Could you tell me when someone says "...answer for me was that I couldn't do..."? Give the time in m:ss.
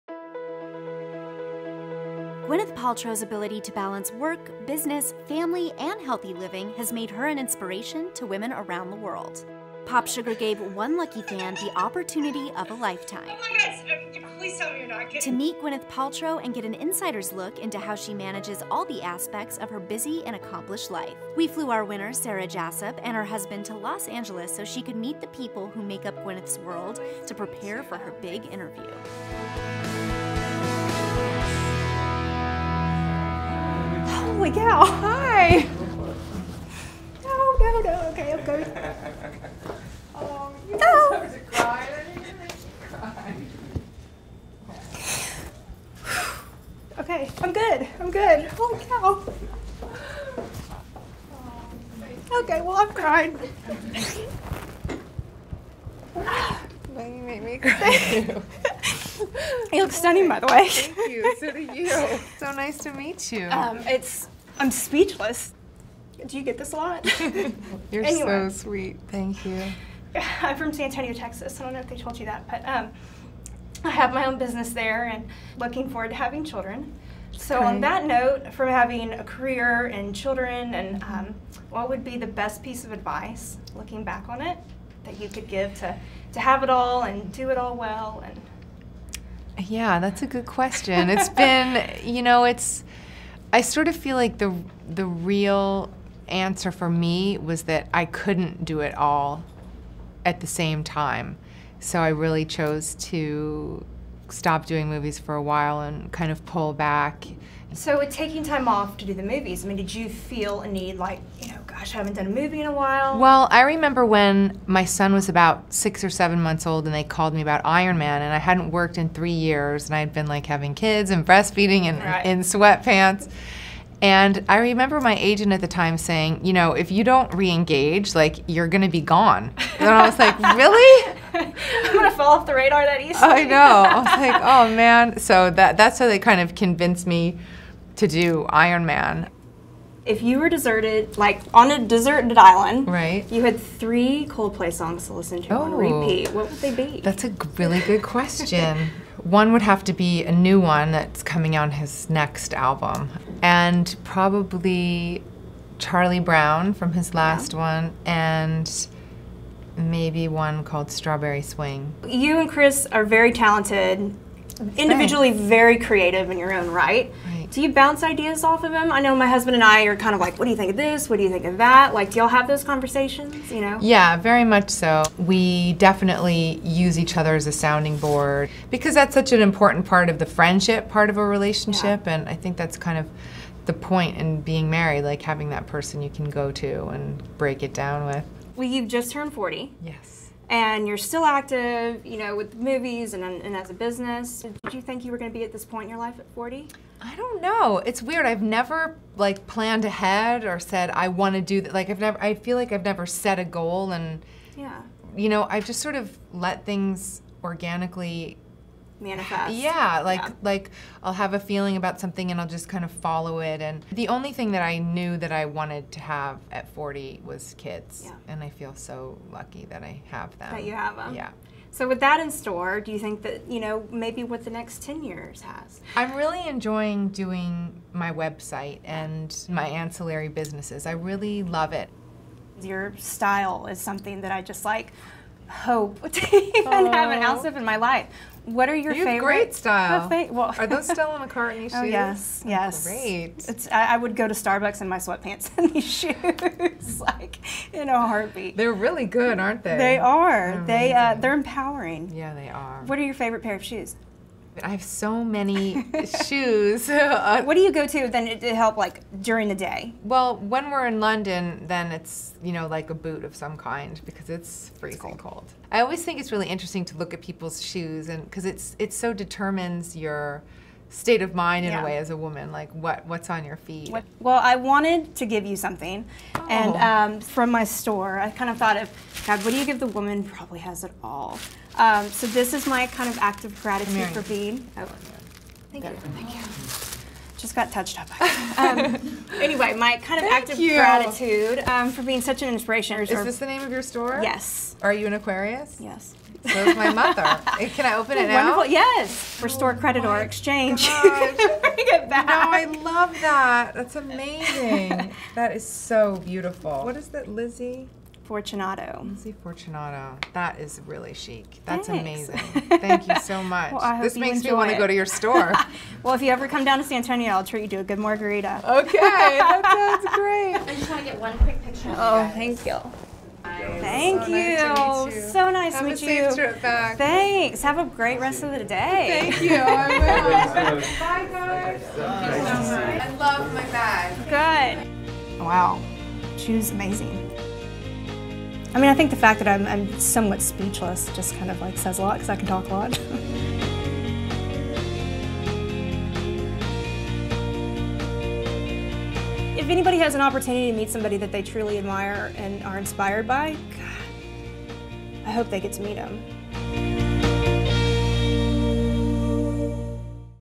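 1:36.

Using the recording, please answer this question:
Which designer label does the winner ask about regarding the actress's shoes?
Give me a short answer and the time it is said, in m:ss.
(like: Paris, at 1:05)
McCartney, at 4:00.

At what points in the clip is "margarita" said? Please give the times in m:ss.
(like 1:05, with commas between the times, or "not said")
5:17.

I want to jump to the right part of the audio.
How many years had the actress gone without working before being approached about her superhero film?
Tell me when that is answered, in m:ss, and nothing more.
1:59.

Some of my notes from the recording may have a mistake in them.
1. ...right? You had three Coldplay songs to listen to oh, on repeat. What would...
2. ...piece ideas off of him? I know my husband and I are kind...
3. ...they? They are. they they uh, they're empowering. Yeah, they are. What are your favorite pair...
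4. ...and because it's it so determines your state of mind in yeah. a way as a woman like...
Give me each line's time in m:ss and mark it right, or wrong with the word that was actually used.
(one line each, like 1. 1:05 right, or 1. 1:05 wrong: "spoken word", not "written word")
1. 2:22 right
2. 2:47 wrong: "bounce", not "piece"
3. 4:09 right
4. 4:28 right.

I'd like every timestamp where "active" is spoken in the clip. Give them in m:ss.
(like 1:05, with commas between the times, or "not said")
3:11, 4:50.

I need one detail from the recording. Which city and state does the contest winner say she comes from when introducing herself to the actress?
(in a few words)
San Antonio, Texas.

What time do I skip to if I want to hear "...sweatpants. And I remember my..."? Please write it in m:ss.
2:02.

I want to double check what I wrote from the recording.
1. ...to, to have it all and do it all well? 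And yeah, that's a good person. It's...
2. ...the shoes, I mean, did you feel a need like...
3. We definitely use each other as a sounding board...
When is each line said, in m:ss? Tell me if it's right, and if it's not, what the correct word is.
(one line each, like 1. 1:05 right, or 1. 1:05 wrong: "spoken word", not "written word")
1. 1:25 wrong: "question", not "person"
2. 1:49 wrong: "movies", not "shoes"
3. 2:55 right.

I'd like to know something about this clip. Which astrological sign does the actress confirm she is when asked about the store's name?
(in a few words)
Aquarius.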